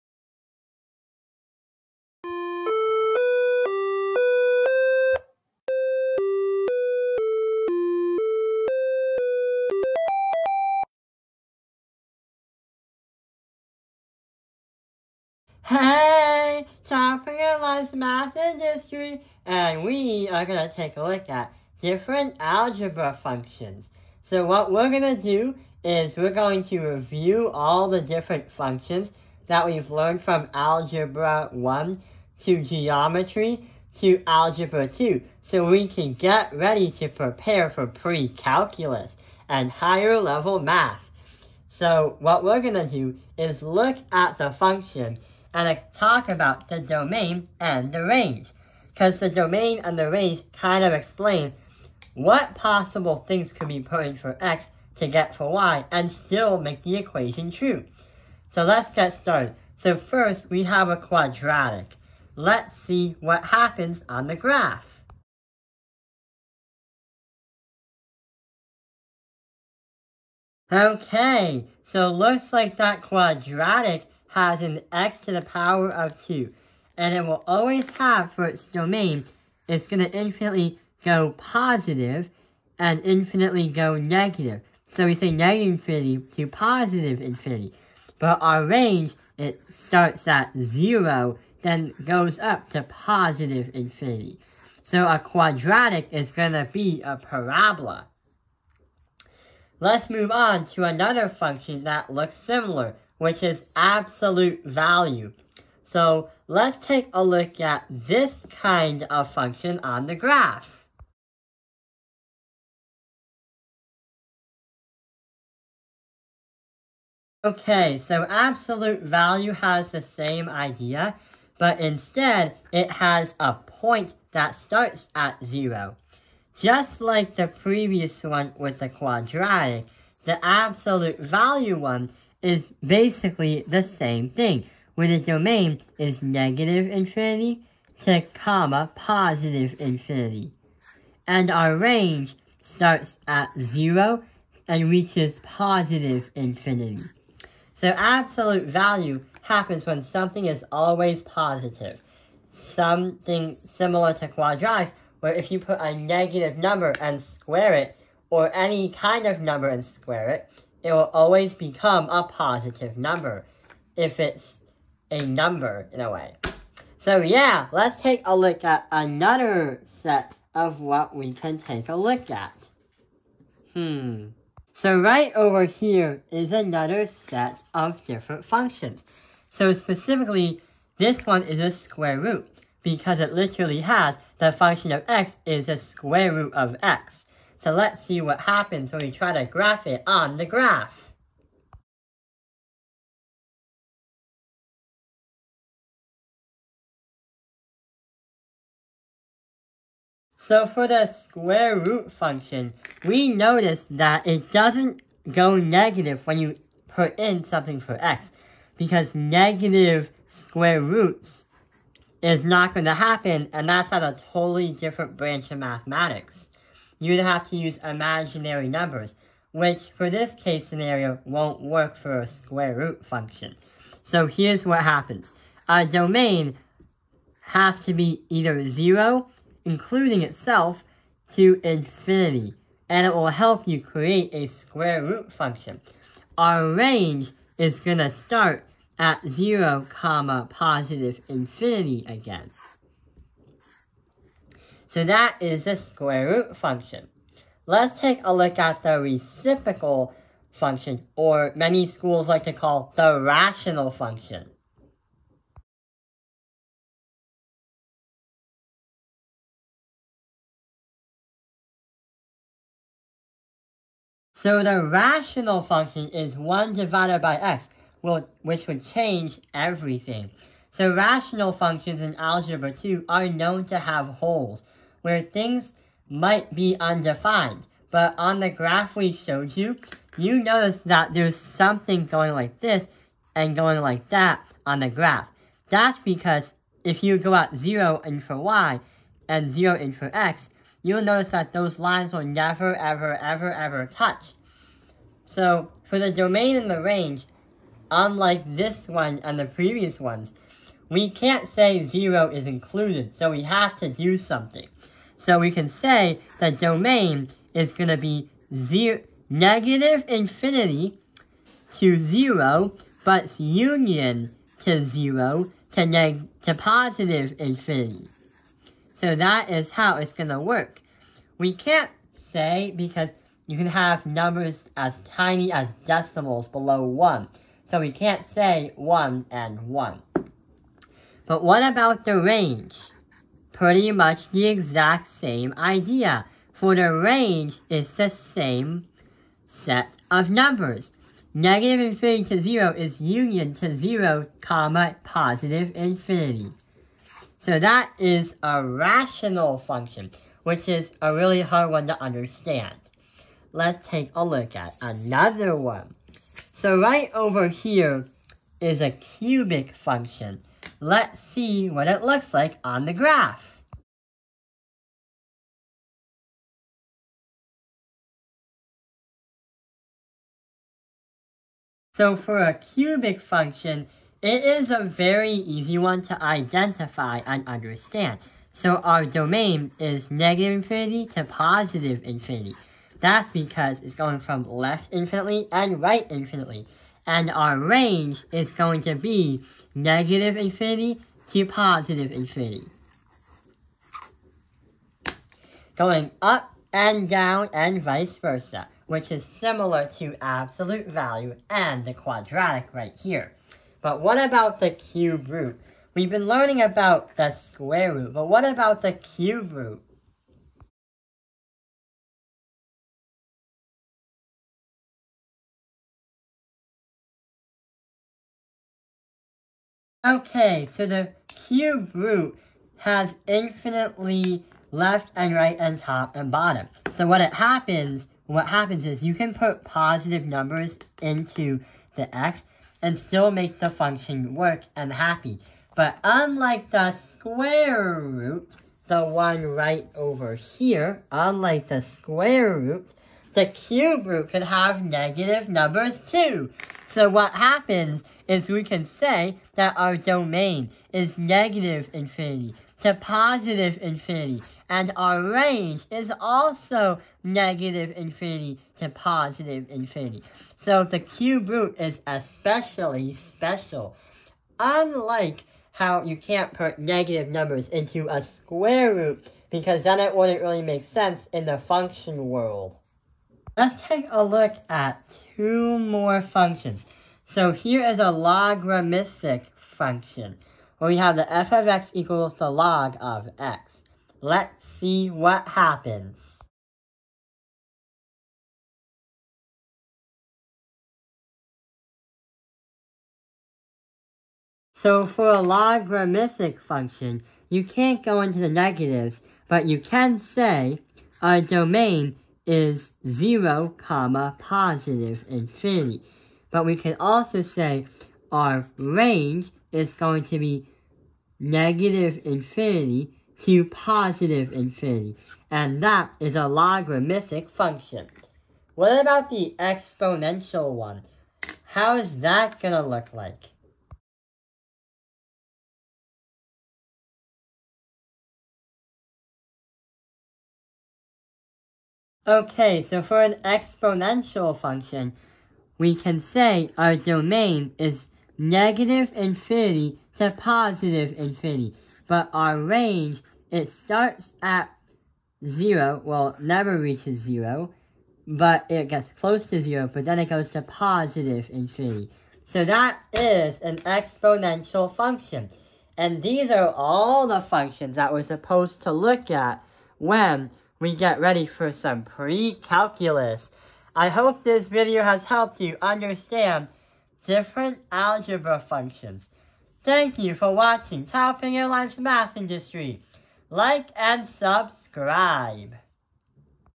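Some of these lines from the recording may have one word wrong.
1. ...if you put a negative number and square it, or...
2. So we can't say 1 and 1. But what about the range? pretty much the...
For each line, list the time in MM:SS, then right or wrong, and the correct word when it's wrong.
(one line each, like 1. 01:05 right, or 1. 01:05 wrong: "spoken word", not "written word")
1. 02:35 right
2. 05:27 right.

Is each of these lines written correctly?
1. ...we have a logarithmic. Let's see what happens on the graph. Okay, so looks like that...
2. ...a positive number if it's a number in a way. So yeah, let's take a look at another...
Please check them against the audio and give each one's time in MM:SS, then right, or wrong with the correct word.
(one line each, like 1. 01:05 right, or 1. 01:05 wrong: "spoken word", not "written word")
1. 01:00 wrong: "quadratic", not "logarithmic"
2. 02:42 right.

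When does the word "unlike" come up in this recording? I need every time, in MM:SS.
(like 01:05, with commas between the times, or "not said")
04:57, 07:16, 07:21, 07:44.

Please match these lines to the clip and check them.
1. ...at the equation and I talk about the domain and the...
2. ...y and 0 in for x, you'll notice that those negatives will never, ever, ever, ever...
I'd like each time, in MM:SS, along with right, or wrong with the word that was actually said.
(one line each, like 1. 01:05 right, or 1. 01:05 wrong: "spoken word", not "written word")
1. 00:44 wrong: "function", not "equation"
2. 04:48 wrong: "lines", not "negatives".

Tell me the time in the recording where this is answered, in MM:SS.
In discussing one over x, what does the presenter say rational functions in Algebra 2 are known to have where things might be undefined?
04:34.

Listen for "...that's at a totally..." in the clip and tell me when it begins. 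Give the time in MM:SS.
03:33.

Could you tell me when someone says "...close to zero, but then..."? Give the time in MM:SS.
09:09.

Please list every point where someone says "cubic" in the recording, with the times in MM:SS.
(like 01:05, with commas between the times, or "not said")
05:58, 06:12.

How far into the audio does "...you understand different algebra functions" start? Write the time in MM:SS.
09:25.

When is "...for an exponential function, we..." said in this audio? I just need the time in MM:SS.
08:53.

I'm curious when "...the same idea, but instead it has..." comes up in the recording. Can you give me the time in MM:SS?
01:59.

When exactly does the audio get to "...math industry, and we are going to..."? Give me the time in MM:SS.
00:17.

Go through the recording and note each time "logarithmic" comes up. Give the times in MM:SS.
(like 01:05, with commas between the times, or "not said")
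07:58, 08:15, 08:36.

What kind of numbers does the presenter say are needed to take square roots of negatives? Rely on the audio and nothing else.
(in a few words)
imaginary numbers.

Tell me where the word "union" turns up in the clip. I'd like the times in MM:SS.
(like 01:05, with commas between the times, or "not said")
05:13, 05:42.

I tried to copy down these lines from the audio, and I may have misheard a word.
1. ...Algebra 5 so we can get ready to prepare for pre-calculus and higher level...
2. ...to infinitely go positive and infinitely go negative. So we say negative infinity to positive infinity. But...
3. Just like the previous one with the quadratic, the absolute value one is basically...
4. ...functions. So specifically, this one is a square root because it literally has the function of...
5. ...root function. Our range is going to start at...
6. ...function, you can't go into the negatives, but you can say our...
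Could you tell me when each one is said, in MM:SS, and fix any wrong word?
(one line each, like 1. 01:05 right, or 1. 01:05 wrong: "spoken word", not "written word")
1. 00:34 wrong: "2", not "5"
2. 01:19 right
3. 02:06 right
4. 02:58 right
5. 03:55 right
6. 08:16 right.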